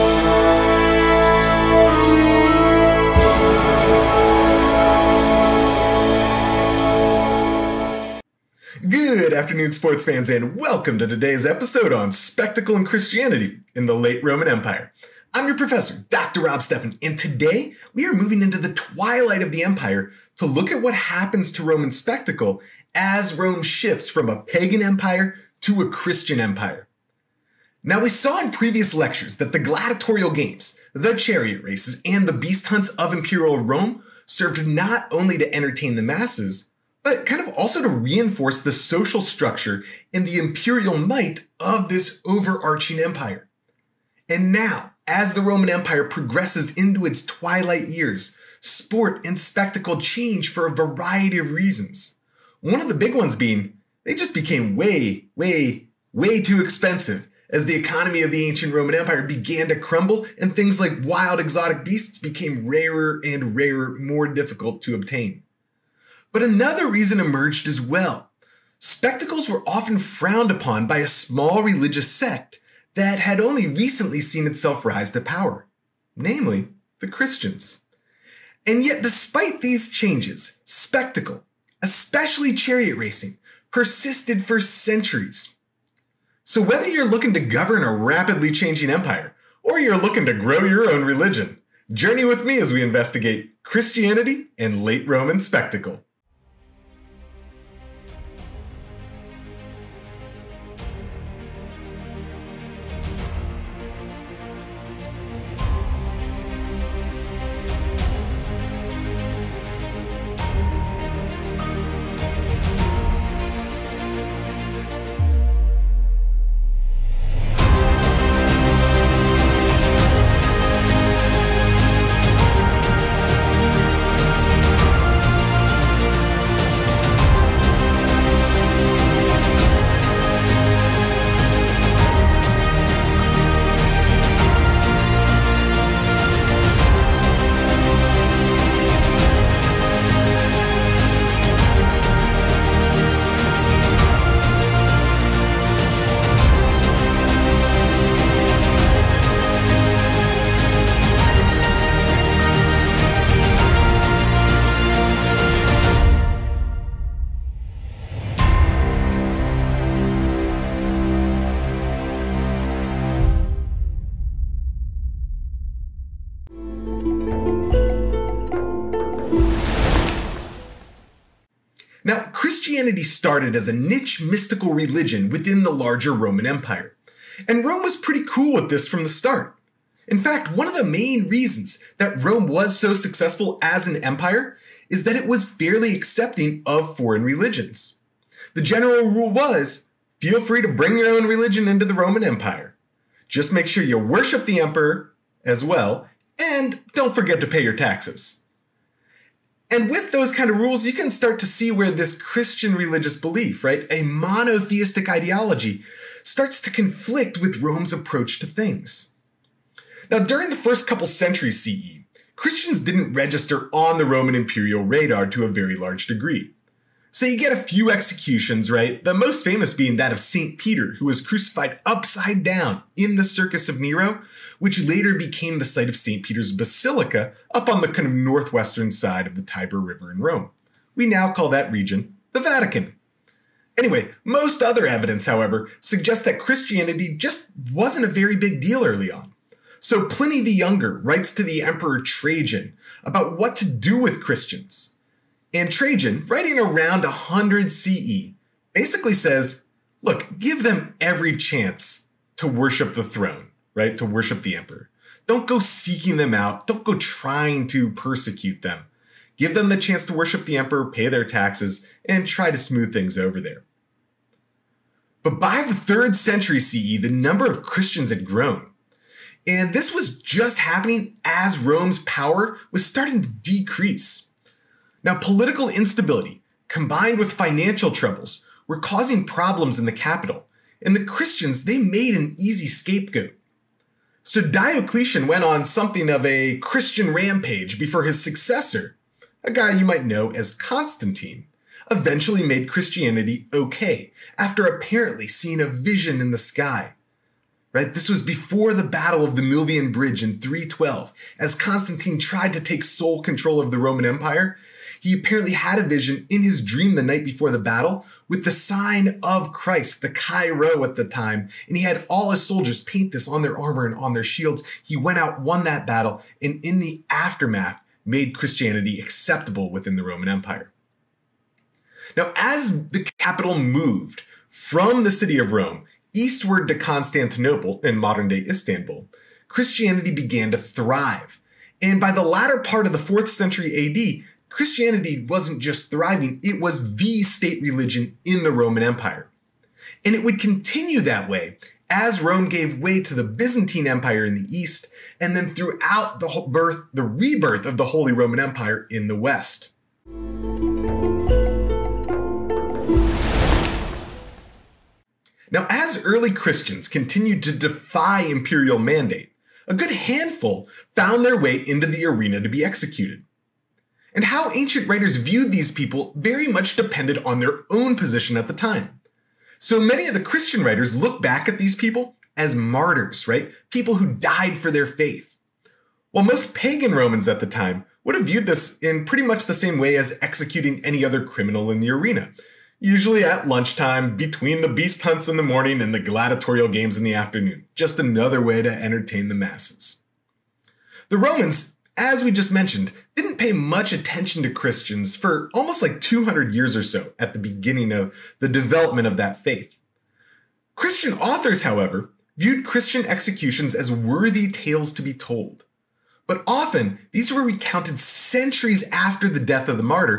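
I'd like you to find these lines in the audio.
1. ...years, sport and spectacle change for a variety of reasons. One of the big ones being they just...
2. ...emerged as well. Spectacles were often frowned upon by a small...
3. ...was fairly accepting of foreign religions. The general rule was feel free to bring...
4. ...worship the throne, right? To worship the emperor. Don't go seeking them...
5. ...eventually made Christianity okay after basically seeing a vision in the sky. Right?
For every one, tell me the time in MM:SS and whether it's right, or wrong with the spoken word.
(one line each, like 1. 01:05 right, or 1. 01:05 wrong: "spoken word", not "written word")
1. 00:47 right
2. 01:07 right
3. 03:05 right
4. 04:12 right
5. 04:51 wrong: "apparently", not "basically".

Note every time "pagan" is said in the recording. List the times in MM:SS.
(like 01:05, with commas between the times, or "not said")
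00:24, 06:16.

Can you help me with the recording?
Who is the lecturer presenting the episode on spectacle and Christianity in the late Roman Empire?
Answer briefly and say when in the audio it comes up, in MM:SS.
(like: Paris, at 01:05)
Rob Steffen, at 00:16.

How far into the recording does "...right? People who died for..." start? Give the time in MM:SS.
06:13.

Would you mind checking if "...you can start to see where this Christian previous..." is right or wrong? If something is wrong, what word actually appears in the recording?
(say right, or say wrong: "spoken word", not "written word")
wrong: "religious", not "previous".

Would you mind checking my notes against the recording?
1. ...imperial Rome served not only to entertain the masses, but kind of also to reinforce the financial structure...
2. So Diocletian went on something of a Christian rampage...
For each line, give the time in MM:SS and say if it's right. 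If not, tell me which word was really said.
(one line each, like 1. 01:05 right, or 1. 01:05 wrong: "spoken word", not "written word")
1. 00:33 wrong: "social", not "financial"
2. 04:44 right.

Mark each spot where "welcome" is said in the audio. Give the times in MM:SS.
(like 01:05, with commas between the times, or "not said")
00:10.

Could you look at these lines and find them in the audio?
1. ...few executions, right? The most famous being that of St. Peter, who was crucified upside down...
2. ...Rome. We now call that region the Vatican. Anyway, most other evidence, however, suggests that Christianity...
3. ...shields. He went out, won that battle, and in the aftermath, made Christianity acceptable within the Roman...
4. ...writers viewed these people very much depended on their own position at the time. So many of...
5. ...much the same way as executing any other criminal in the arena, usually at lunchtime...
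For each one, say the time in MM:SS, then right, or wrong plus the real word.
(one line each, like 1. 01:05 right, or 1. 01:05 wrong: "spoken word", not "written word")
1. 03:37 right
2. 03:50 right
3. 05:14 right
4. 06:04 right
5. 06:19 right.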